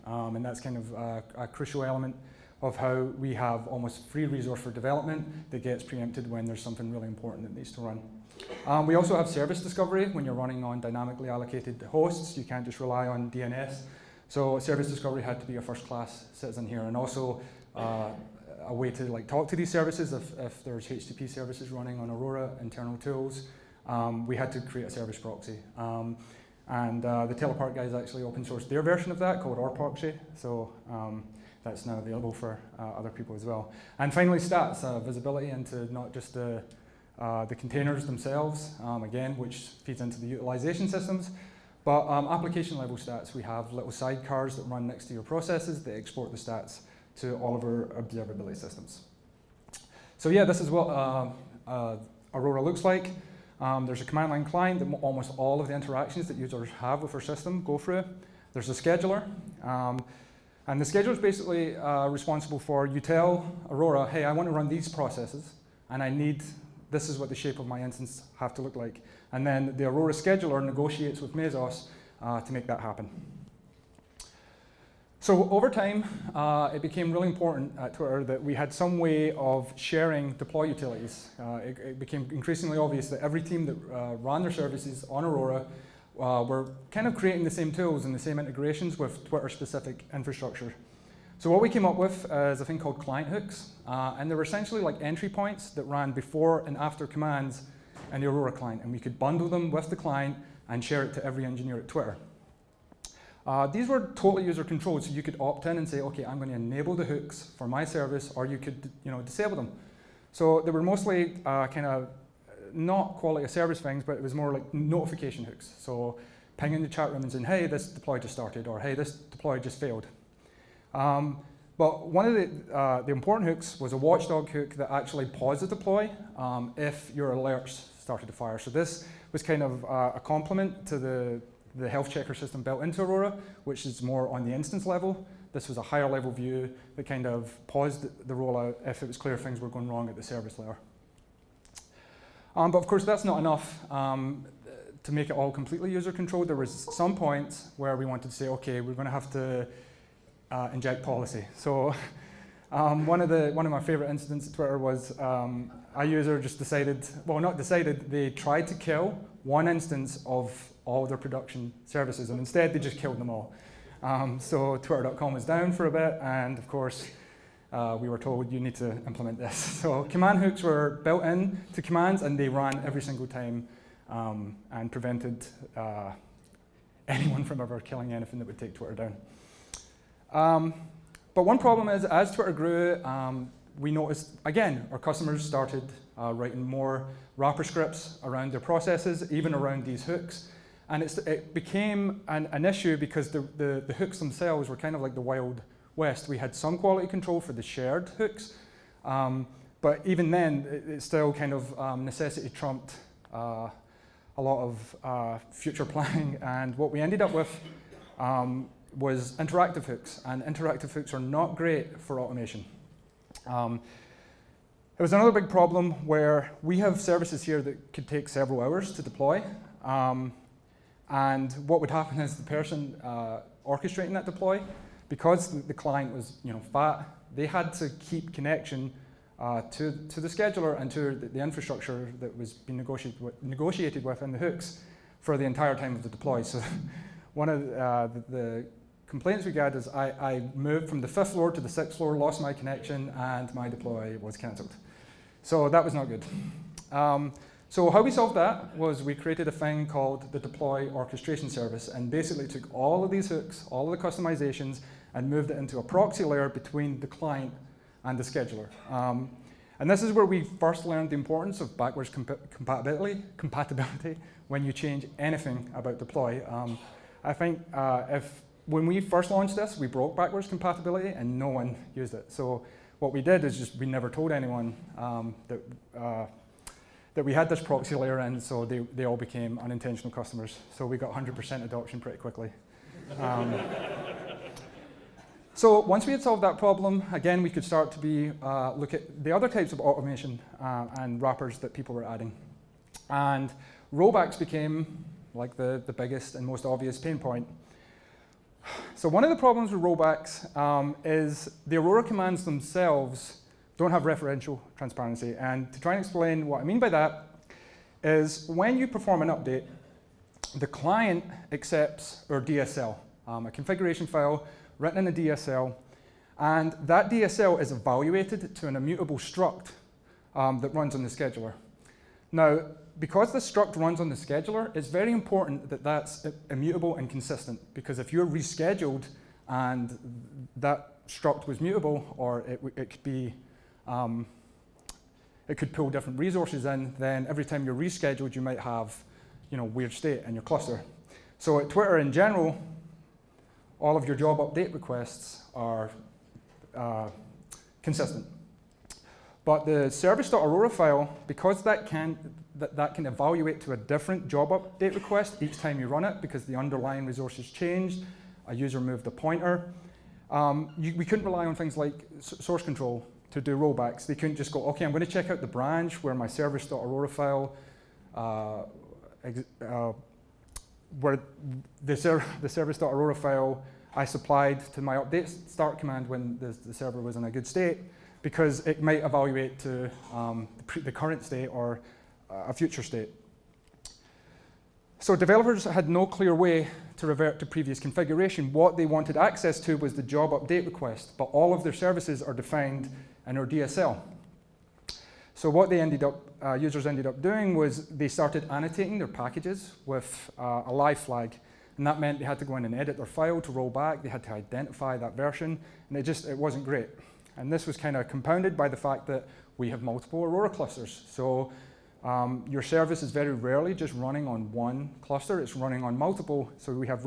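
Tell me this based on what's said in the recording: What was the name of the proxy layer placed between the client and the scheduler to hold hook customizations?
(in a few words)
deploy orchestration service.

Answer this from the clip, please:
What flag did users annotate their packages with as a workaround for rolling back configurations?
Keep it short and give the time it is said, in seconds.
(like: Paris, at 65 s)
live, at 400 s.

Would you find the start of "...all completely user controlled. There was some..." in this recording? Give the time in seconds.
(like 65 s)
145 s.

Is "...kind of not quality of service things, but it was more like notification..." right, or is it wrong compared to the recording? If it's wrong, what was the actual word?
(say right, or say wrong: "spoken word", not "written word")
right.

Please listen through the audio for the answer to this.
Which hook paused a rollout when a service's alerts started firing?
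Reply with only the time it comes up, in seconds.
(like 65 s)
123 s.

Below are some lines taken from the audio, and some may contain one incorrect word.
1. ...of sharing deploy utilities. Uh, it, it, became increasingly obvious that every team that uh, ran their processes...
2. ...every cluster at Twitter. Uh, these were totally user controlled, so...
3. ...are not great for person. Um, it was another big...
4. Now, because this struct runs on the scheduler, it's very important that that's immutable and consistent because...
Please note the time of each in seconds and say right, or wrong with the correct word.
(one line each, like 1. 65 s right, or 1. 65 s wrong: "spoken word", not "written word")
1. 79 s wrong: "services", not "processes"
2. 101 s wrong: "engineer", not "cluster"
3. 211 s wrong: "automation", not "person"
4. 322 s right.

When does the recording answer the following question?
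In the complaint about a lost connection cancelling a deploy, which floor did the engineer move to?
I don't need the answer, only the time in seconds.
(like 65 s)
241 s.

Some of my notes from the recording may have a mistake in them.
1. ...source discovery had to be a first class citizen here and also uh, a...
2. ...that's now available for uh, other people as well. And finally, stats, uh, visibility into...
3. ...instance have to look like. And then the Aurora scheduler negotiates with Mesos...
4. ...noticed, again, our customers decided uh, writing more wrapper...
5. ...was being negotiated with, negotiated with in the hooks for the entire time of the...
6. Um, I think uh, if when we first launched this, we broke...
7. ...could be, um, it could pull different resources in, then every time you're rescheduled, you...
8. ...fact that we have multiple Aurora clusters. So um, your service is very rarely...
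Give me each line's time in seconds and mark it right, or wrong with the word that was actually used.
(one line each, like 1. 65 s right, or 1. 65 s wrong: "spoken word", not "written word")
1. 14 s wrong: "service", not "source"
2. 31 s right
3. 67 s right
4. 183 s wrong: "started", not "decided"
5. 232 s right
6. 266 s right
7. 332 s right
8. 408 s right.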